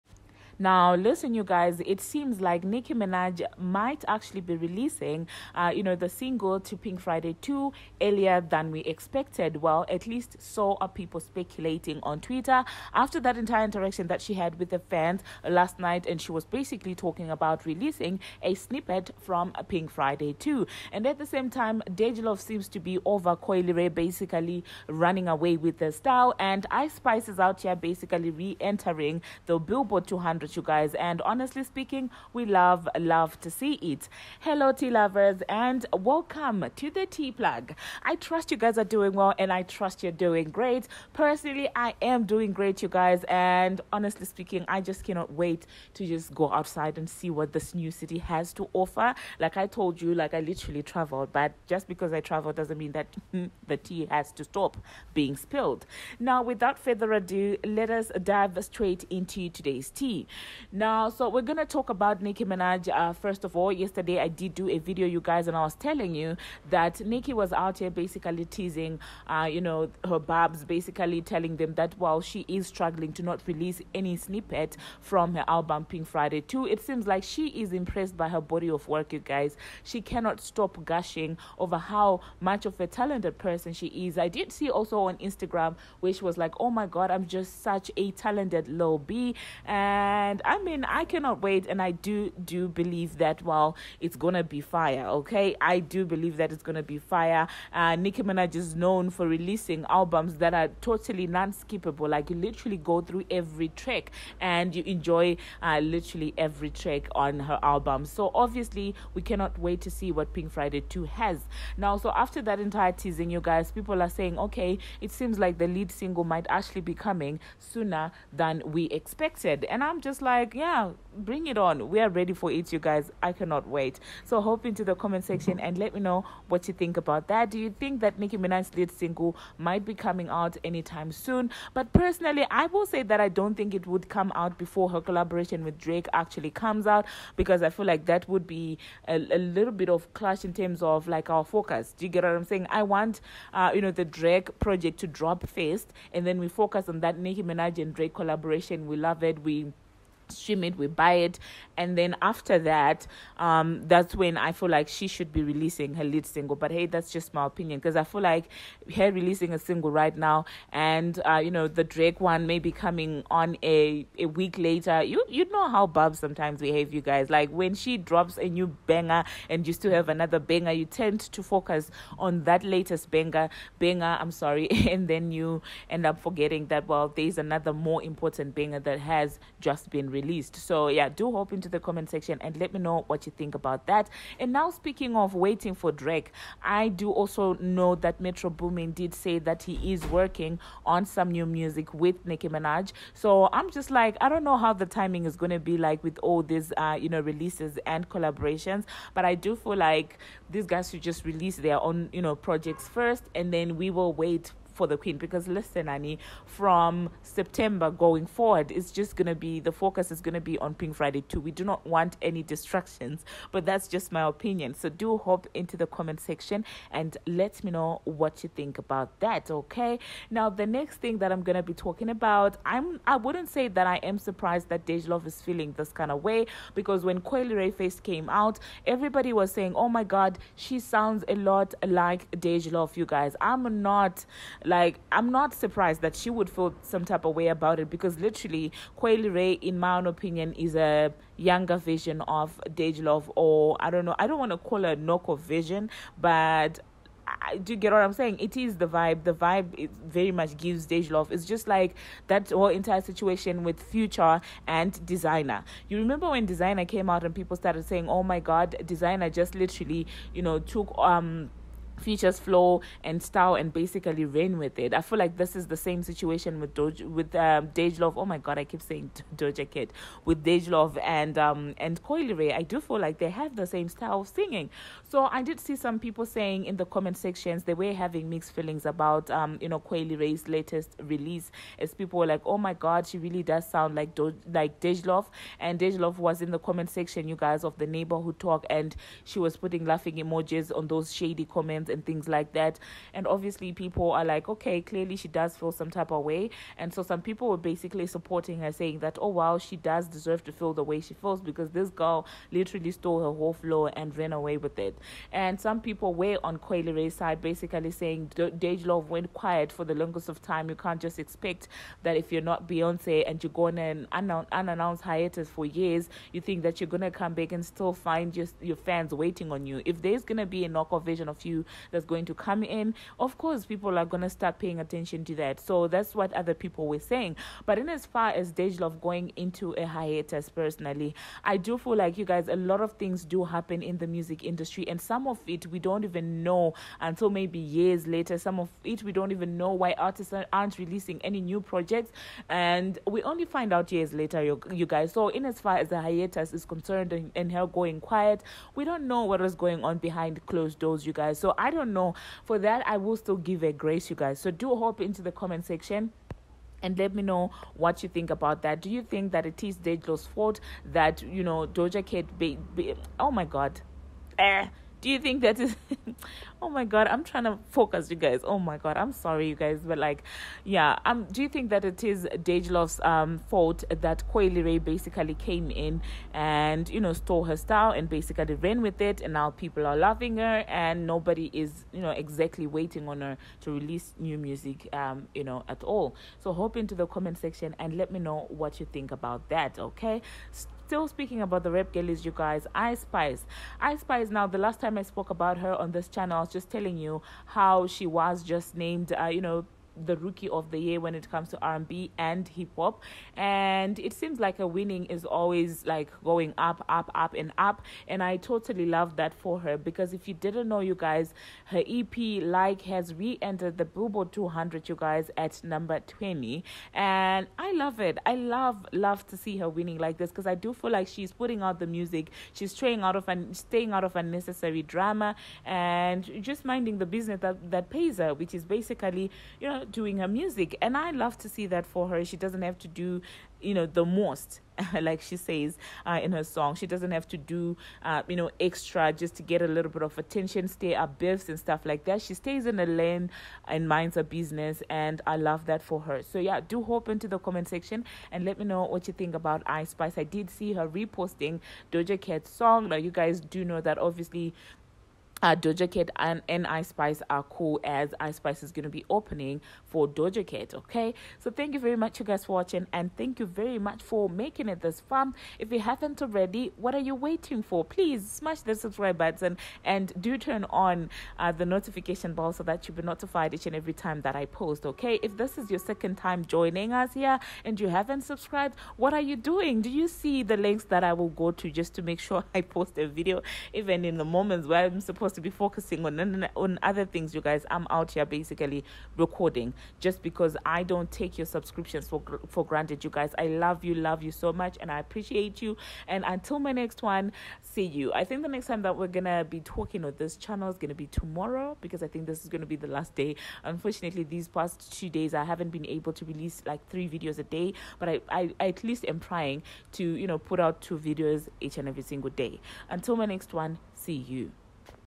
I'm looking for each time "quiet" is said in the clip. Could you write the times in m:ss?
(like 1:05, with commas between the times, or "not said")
5:09, 5:47.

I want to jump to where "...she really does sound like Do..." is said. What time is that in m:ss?
4:43.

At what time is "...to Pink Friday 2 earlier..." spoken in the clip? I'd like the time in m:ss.
0:06.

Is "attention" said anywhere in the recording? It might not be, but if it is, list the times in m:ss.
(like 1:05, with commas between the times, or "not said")
5:24, 7:20.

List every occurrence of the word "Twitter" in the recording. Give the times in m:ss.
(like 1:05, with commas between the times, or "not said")
0:12.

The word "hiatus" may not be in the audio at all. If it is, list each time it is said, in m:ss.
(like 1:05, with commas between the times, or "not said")
5:15, 5:29, 5:46.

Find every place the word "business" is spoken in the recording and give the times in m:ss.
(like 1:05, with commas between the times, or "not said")
7:07, 7:24.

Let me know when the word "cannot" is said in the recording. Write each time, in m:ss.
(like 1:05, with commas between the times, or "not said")
0:45, 1:20, 1:31, 1:49, 2:03.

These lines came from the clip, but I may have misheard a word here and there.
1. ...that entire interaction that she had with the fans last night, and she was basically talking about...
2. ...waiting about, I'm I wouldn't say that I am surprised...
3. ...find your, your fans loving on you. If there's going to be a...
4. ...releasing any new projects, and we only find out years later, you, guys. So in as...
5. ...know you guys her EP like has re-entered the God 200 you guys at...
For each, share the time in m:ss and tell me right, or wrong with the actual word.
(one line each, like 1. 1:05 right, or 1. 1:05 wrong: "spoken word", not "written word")
1. 0:13 right
2. 3:41 wrong: "talking", not "waiting"
3. 5:17 wrong: "waiting", not "loving"
4. 5:40 right
5. 6:50 wrong: "Billboard", not "God".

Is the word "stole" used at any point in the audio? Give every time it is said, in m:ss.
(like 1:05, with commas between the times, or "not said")
5:02, 6:17.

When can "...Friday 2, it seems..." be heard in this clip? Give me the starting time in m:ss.
1:16.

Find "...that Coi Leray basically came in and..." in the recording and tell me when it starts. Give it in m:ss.
6:14.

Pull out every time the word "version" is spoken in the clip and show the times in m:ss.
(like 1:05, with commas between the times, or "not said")
4:01, 5:21.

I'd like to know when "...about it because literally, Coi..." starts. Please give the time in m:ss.
3:57.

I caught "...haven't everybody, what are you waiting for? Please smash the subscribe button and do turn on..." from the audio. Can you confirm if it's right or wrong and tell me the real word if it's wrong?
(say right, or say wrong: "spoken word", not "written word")
wrong: "already", not "everybody".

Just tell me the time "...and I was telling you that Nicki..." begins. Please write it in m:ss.
1:05.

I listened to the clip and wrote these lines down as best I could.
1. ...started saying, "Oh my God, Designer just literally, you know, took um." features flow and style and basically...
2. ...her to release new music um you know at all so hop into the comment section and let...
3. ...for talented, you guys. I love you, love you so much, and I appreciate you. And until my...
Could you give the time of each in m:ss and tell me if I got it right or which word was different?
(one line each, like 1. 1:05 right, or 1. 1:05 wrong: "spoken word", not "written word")
1. 4:17 right
2. 6:23 right
3. 8:12 wrong: "granted", not "talented".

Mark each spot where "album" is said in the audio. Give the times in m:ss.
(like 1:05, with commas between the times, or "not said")
1:15, 1:39, 1:47.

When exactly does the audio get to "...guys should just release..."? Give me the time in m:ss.
3:20.